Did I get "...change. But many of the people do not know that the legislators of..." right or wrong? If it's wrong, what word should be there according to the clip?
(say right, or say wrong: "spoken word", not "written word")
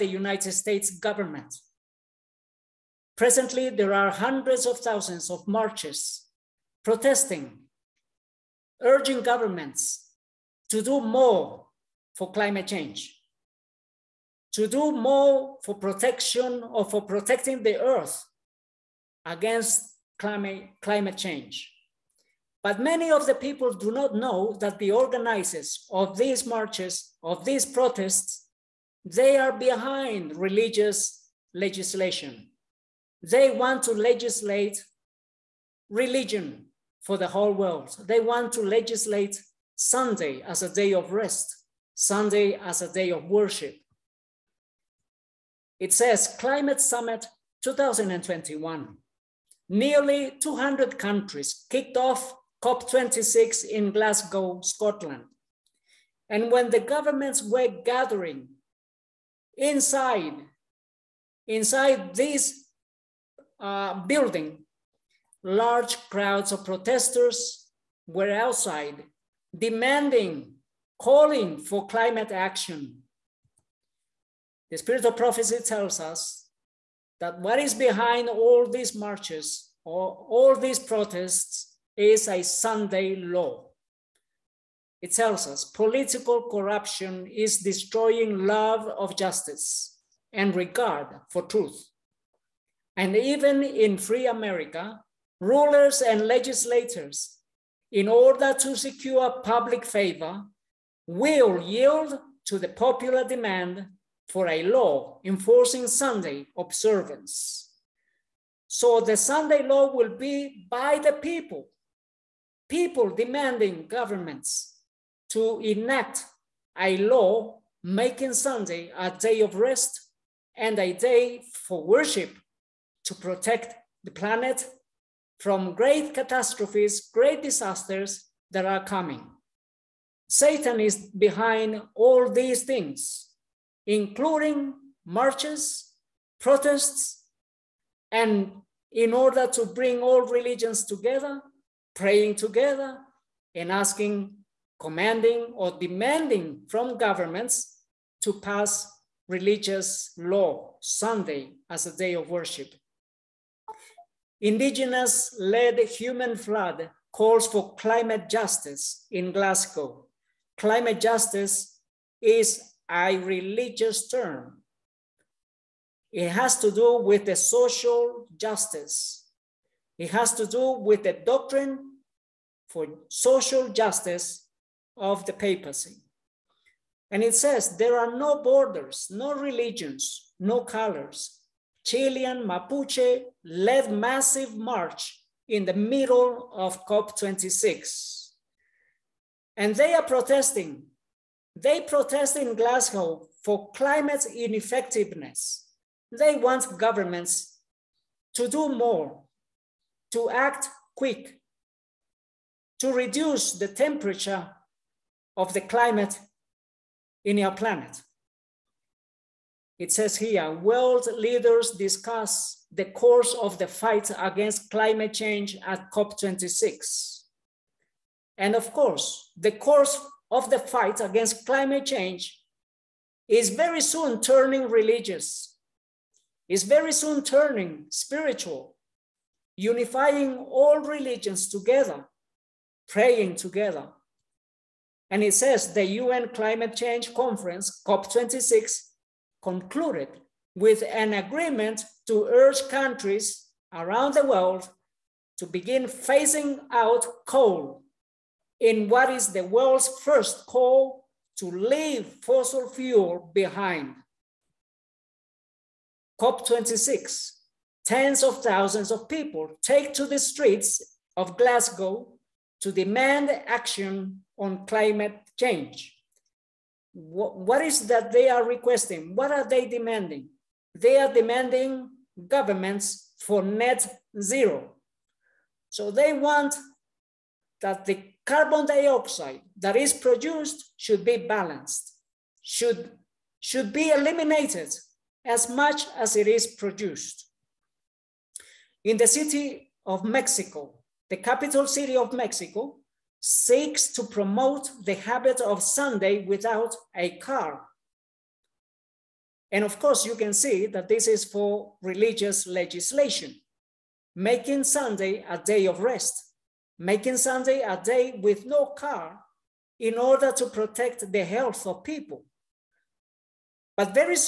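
wrong: "organizers", not "legislators".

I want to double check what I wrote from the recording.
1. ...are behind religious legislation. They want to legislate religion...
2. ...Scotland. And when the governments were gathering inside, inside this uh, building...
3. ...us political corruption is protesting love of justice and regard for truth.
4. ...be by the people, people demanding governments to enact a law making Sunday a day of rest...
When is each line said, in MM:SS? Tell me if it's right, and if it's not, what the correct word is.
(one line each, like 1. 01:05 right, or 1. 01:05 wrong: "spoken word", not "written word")
1. 00:29 right
2. 00:54 right
3. 01:25 wrong: "destroying", not "protesting"
4. 01:50 right.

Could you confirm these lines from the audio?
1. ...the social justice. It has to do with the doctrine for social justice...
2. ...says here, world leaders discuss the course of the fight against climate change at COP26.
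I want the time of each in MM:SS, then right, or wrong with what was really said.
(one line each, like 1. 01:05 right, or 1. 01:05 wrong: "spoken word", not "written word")
1. 02:47 right
2. 03:29 right.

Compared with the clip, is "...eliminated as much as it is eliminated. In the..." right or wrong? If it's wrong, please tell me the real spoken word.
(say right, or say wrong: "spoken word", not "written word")
wrong: "produced", not "eliminated".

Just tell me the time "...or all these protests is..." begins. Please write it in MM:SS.
01:19.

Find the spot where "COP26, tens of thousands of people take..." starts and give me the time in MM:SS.
04:16.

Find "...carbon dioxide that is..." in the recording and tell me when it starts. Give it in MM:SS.
04:38.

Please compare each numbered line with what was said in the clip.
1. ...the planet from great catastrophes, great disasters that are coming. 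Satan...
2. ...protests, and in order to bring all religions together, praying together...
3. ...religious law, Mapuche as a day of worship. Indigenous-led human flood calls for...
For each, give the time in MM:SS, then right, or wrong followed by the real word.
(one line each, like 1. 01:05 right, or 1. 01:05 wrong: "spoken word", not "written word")
1. 02:04 right
2. 02:16 right
3. 02:29 wrong: "Sunday", not "Mapuche".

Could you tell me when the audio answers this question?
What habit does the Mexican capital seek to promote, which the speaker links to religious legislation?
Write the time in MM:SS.
04:55.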